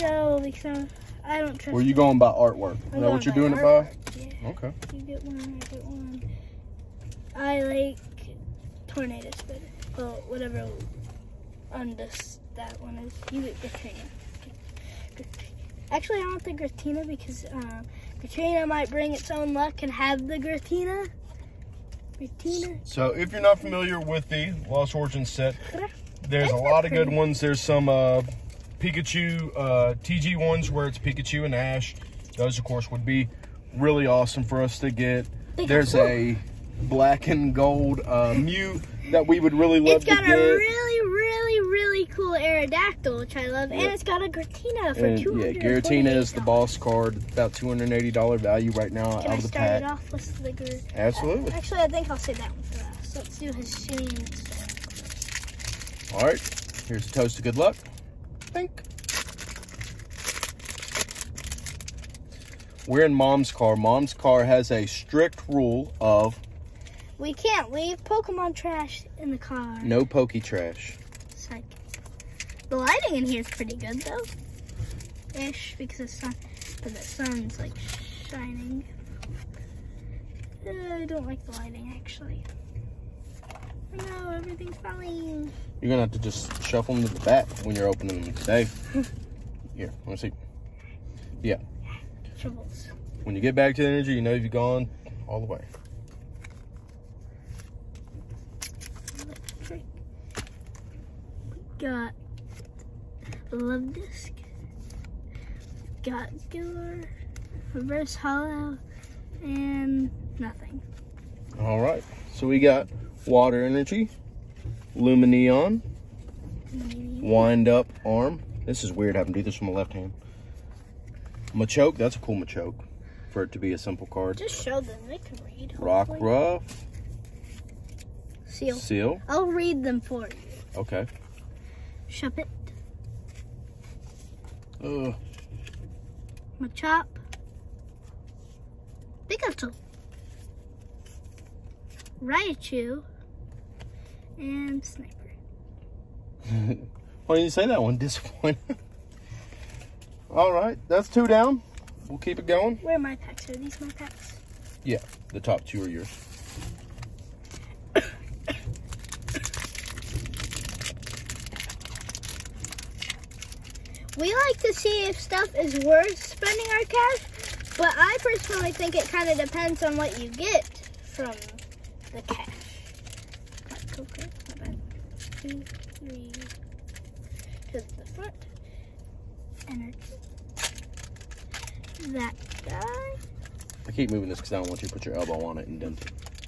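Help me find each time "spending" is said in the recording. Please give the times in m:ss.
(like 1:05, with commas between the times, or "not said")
2:46.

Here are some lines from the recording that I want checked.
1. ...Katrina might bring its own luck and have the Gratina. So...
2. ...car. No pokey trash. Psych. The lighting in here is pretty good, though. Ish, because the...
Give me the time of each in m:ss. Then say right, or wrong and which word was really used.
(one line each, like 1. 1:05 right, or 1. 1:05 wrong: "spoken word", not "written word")
1. 0:18 right
2. 1:09 right.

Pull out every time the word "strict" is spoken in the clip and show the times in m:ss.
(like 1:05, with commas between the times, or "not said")
1:04.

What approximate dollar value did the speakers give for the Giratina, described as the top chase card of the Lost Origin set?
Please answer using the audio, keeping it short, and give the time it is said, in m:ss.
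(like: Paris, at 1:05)
$280, at 0:47.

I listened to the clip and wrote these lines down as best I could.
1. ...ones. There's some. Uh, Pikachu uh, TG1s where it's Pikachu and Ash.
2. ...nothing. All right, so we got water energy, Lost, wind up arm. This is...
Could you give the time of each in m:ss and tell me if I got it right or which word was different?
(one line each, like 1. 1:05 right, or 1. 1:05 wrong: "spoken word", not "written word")
1. 0:27 right
2. 1:50 wrong: "Lumineon", not "Lost".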